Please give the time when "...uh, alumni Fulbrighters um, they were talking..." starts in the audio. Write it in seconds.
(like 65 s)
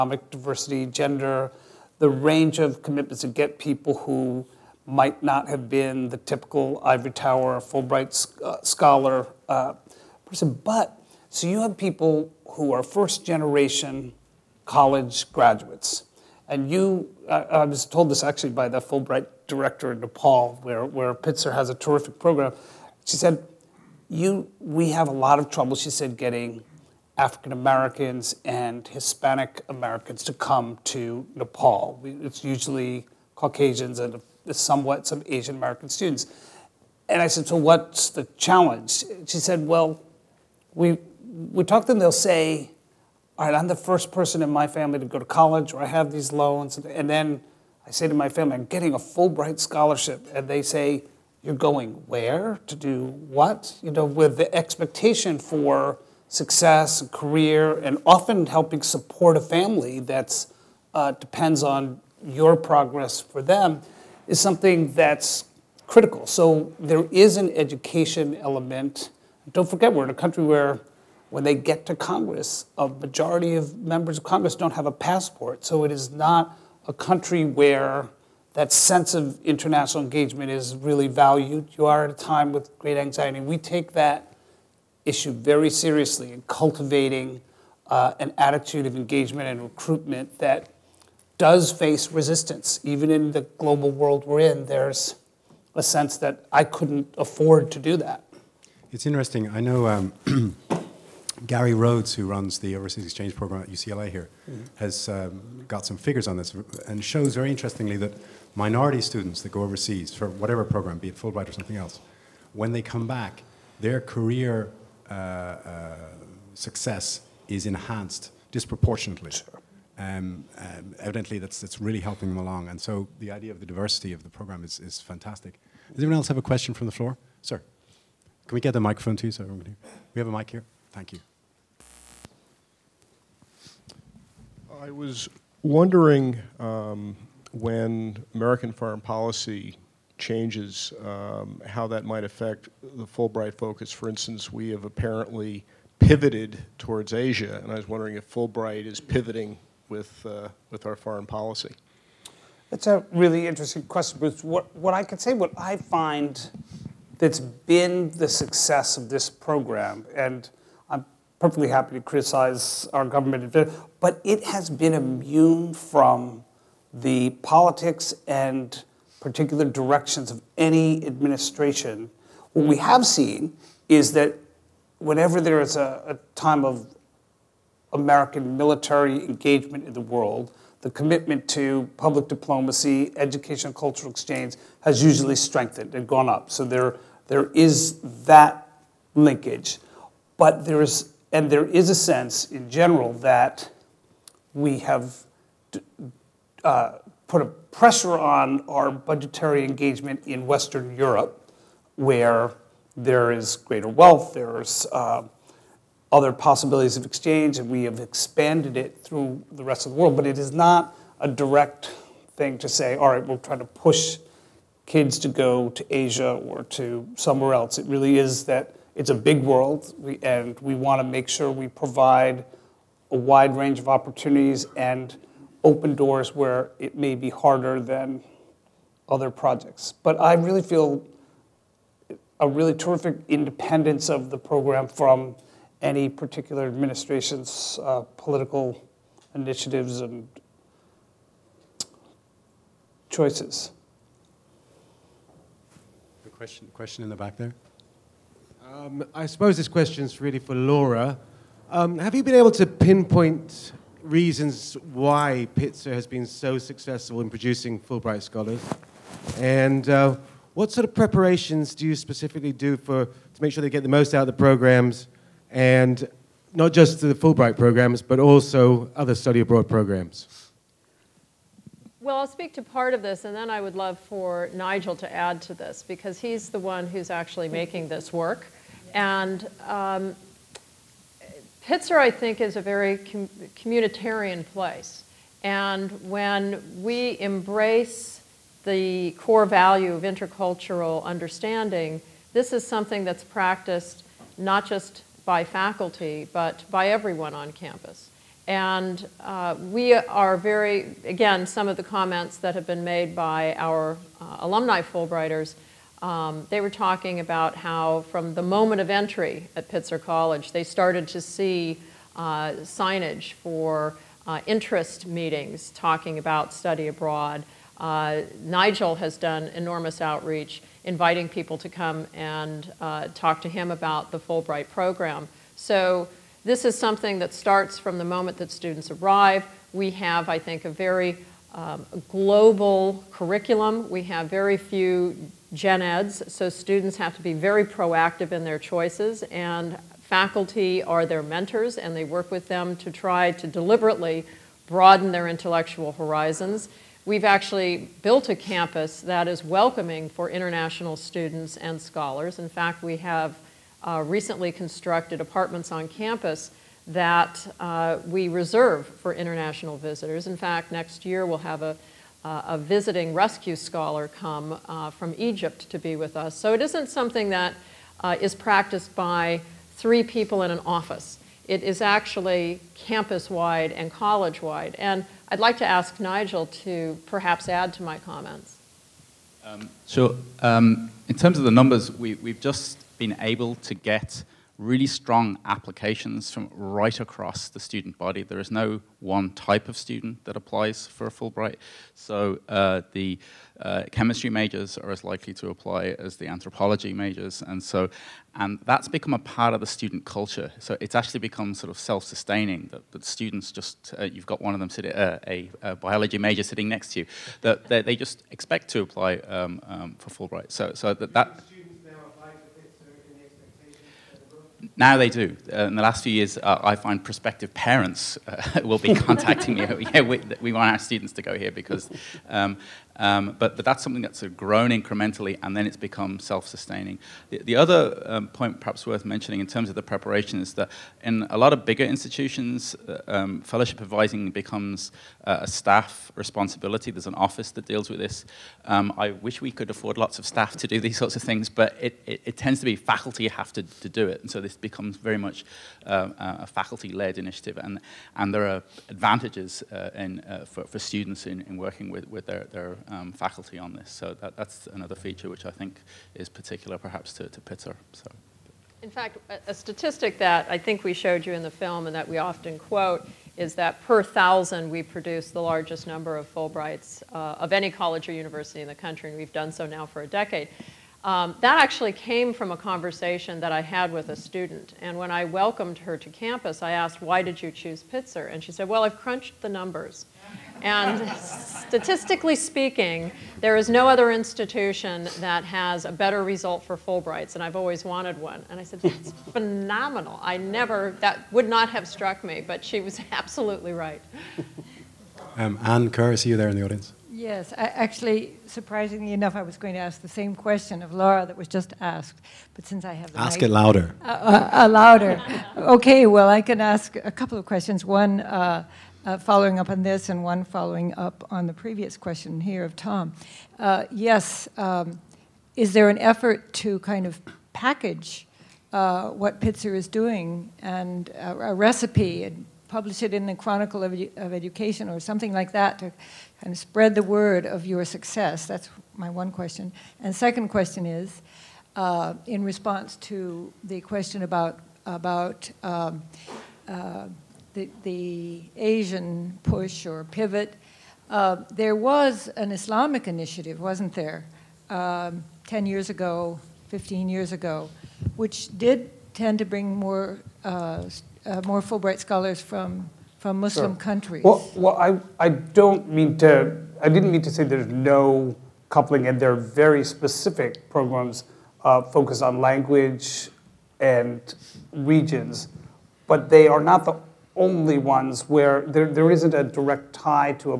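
304 s.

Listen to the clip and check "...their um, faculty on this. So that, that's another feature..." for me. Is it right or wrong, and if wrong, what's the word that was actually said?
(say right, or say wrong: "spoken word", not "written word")
right.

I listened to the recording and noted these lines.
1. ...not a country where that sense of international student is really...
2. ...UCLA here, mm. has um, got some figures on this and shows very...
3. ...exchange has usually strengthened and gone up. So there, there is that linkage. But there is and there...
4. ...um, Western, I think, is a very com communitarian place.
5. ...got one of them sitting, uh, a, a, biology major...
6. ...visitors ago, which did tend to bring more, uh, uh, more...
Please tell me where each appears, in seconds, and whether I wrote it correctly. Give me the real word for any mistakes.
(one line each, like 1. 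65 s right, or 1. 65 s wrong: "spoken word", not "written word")
1. 76 s wrong: "engagement", not "student"
2. 103 s right
3. 184 s right
4. 279 s wrong: "Pitzer", not "Western"
5. 404 s right
6. 547 s wrong: "years", not "visitors".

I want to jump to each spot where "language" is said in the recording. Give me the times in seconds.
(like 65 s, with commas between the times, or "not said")
562 s.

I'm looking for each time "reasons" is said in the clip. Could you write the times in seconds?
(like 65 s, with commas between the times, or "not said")
254 s.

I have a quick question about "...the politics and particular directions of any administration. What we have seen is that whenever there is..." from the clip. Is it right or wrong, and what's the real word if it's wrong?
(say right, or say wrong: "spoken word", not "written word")
right.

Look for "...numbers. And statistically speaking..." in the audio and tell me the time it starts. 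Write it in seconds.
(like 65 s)
479 s.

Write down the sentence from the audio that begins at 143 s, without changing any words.
For instance, we have apparently pivoted towards Asia, and I was wondering if Fulbright is pivoting with, uh, with our foreign policy.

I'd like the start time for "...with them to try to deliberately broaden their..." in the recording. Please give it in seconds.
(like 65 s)
342 s.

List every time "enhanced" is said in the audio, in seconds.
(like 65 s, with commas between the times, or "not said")
117 s.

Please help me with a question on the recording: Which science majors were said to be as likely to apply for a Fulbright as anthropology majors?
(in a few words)
chemistry majors.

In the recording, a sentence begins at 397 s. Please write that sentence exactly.
And so, and that's become a part of the student culture.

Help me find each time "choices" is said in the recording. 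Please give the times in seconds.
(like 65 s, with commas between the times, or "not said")
243 s, 338 s.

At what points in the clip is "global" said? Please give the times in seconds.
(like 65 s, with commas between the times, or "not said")
93 s, 332 s.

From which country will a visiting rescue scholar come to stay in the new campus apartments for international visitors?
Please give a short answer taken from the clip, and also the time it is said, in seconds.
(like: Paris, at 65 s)
Egypt, at 365 s.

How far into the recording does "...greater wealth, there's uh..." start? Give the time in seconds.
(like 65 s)
203 s.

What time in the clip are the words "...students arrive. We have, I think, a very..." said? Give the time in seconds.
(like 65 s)
328 s.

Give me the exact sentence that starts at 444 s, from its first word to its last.
And so this becomes very much uh, a faculty-led initiative.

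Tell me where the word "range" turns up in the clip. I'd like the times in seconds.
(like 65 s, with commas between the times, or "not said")
2 s, 223 s.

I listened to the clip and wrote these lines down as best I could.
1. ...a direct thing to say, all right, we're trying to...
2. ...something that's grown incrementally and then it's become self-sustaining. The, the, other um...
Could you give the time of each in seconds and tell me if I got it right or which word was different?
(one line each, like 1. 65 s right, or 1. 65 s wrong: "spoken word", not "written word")
1. 211 s right
2. 423 s right.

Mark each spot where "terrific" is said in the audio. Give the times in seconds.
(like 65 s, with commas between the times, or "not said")
21 s, 232 s.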